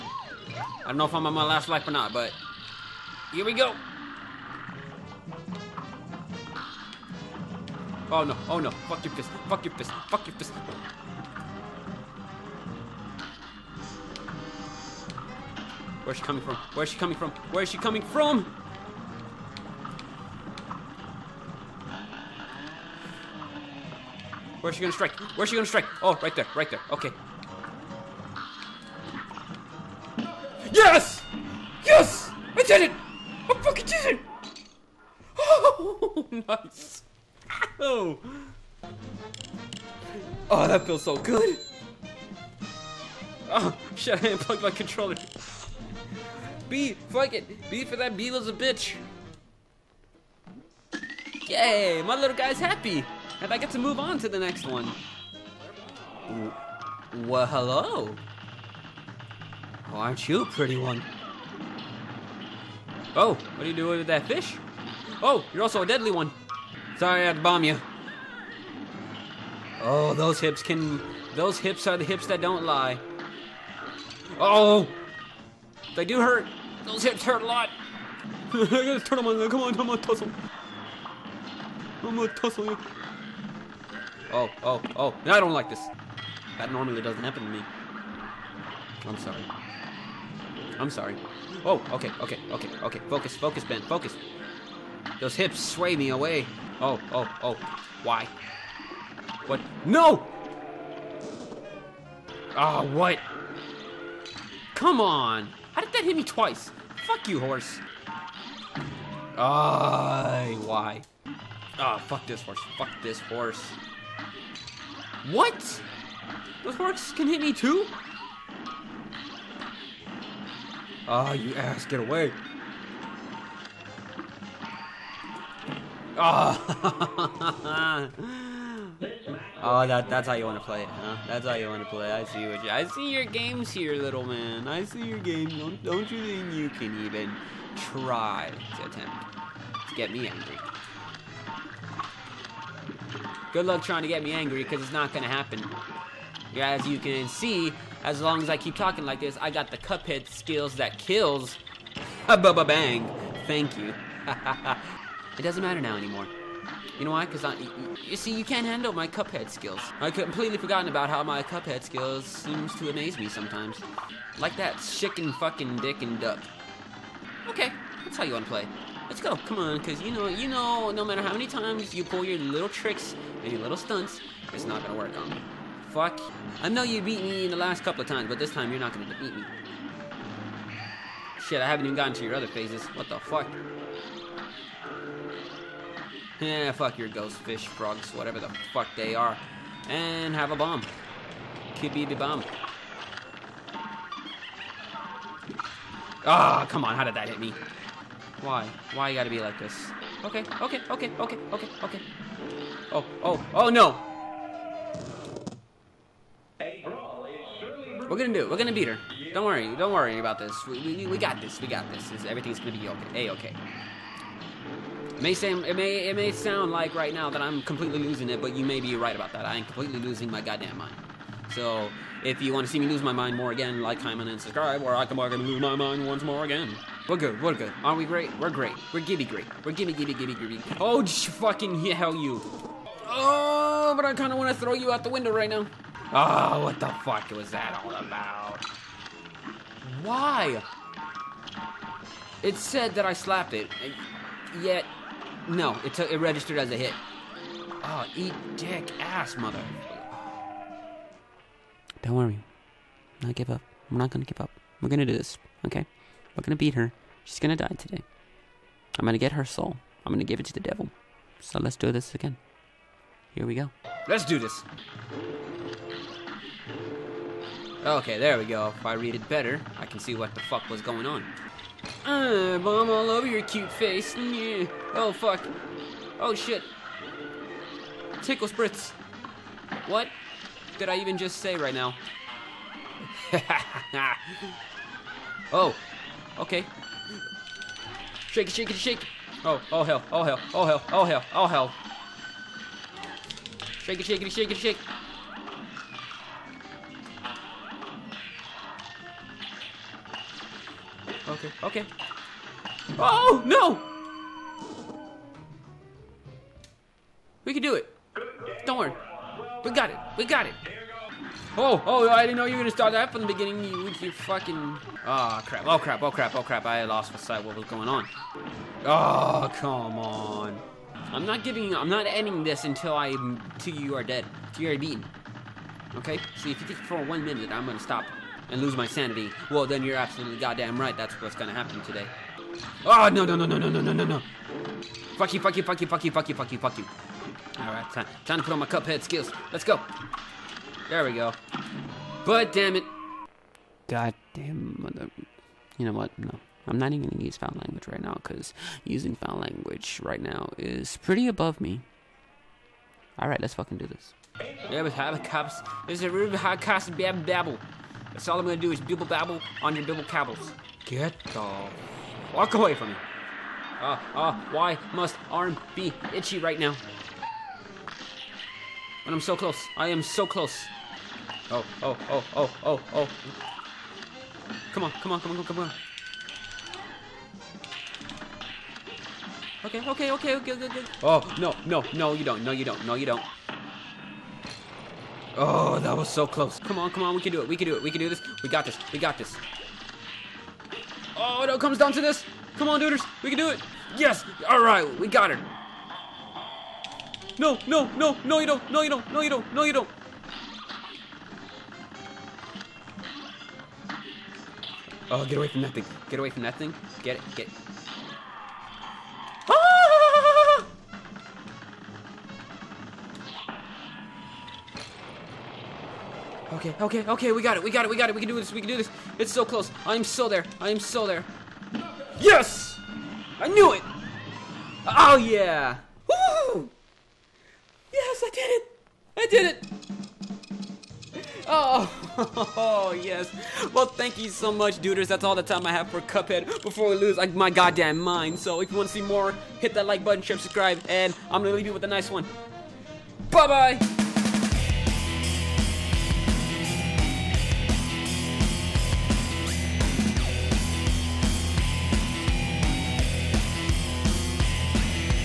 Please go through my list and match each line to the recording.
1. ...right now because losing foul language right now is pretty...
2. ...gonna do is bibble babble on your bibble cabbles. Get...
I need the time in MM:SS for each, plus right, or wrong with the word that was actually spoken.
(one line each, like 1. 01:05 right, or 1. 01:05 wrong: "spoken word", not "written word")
1. 05:47 wrong: "using", not "losing"
2. 05:58 right.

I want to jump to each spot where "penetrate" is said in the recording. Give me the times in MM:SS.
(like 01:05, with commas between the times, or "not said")
not said.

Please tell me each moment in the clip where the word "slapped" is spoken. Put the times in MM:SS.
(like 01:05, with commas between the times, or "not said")
04:03.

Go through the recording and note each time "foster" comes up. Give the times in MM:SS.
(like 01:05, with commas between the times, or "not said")
not said.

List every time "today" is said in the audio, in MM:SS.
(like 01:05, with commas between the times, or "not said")
04:17, 05:31.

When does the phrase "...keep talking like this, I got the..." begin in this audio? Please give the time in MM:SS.
02:28.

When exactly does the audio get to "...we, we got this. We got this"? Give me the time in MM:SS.
03:30.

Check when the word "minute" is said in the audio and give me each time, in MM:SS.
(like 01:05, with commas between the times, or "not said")
05:27.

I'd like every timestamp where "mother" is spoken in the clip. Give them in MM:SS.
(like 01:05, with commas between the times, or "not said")
04:09, 05:44.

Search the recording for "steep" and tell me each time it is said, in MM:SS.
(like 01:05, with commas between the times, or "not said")
not said.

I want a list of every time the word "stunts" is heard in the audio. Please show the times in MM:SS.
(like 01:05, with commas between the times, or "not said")
02:53.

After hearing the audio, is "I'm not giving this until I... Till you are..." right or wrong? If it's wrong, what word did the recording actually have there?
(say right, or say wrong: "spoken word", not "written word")
wrong: "ending", not "giving".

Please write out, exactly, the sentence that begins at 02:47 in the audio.
Okay, that's how you want to play.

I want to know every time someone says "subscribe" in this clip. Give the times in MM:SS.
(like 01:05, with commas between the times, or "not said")
03:44, 07:20.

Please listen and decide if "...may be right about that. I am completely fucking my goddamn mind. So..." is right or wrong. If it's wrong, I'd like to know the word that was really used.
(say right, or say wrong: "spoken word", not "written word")
wrong: "losing", not "fucking".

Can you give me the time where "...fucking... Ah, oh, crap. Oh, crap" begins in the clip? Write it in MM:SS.
05:14.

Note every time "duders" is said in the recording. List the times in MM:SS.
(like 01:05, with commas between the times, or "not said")
06:32, 07:14.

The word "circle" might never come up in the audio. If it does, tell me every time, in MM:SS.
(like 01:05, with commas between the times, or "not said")
not said.